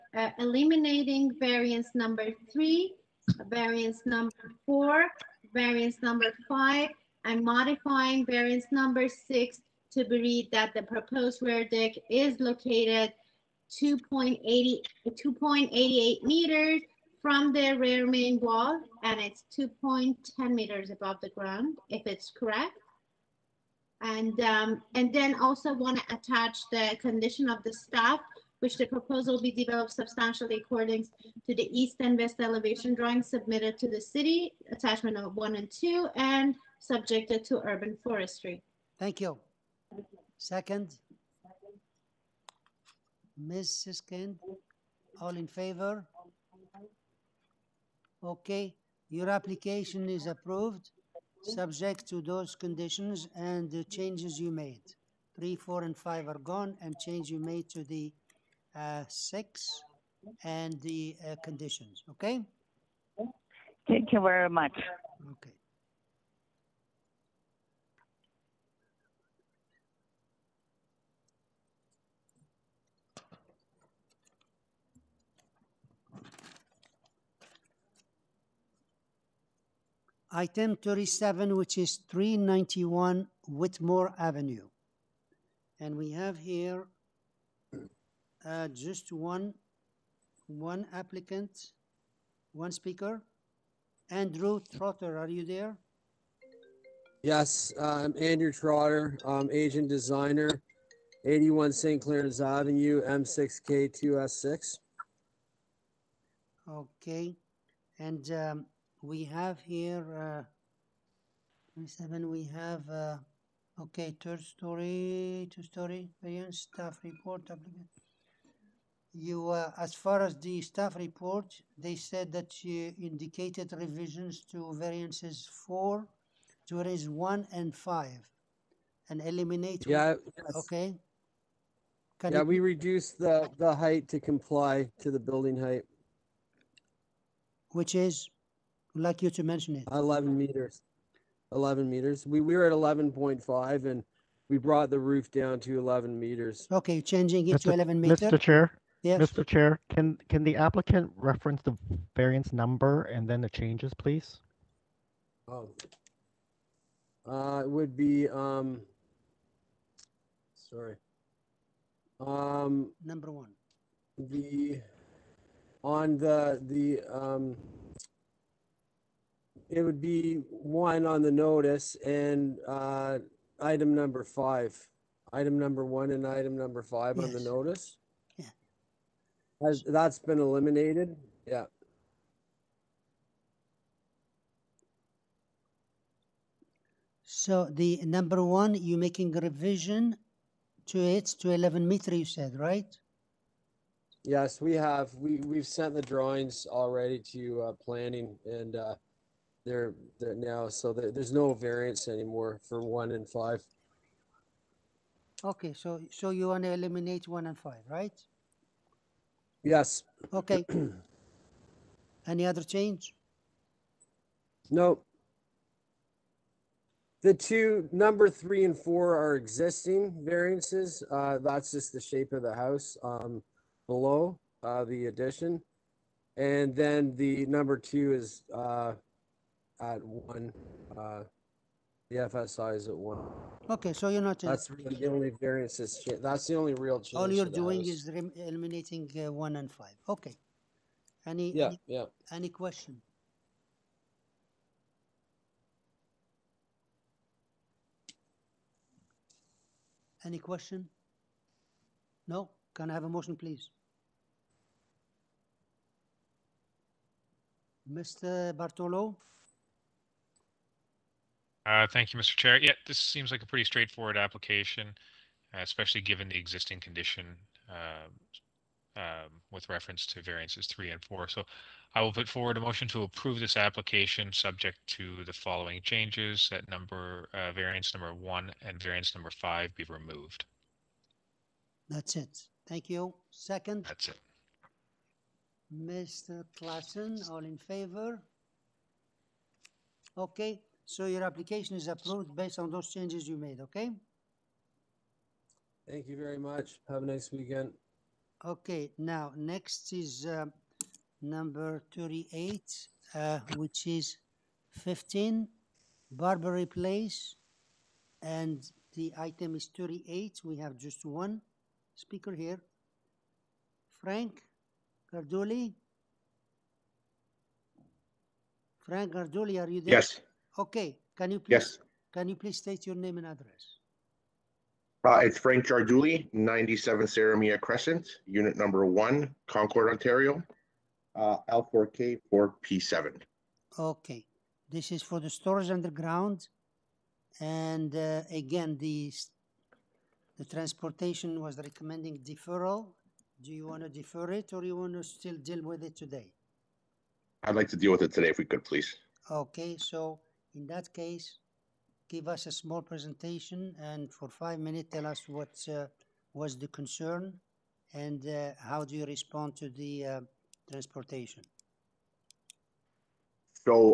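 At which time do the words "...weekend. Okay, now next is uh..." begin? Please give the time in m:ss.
4:57.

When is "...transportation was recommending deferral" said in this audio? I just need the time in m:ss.
5:40.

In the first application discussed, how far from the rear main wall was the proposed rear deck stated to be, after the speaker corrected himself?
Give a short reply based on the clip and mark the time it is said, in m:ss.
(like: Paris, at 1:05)
2.88 meters, at 0:15.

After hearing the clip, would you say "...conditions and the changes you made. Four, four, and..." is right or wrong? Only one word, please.
wrong.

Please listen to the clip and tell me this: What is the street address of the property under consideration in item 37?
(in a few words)
391 Whitmore Avenue.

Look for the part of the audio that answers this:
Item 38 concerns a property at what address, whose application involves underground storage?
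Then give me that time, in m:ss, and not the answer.
5:04.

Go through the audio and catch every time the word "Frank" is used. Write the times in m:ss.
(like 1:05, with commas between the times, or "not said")
5:14, 5:18, 5:25.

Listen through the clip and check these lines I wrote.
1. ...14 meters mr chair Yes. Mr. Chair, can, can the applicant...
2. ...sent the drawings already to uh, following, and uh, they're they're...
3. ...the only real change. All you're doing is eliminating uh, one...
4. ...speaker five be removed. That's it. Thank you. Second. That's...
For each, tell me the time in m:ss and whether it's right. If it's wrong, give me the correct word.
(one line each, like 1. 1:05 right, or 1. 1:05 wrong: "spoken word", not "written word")
1. 2:27 wrong: "11", not "14"
2. 3:15 wrong: "planning", not "following"
3. 3:56 right
4. 4:39 wrong: "number", not "speaker".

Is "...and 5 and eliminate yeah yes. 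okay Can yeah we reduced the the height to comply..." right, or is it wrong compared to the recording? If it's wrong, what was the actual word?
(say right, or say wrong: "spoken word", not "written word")
right.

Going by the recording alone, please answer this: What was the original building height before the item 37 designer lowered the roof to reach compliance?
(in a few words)
11.5 meters.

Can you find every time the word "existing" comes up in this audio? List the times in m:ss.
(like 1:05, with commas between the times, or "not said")
3:39, 4:26.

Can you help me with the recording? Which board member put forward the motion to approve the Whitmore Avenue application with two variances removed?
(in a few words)
Mr. Bartolo.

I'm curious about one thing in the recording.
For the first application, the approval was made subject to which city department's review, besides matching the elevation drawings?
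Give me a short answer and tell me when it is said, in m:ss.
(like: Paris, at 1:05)
Urban forestry, at 0:37.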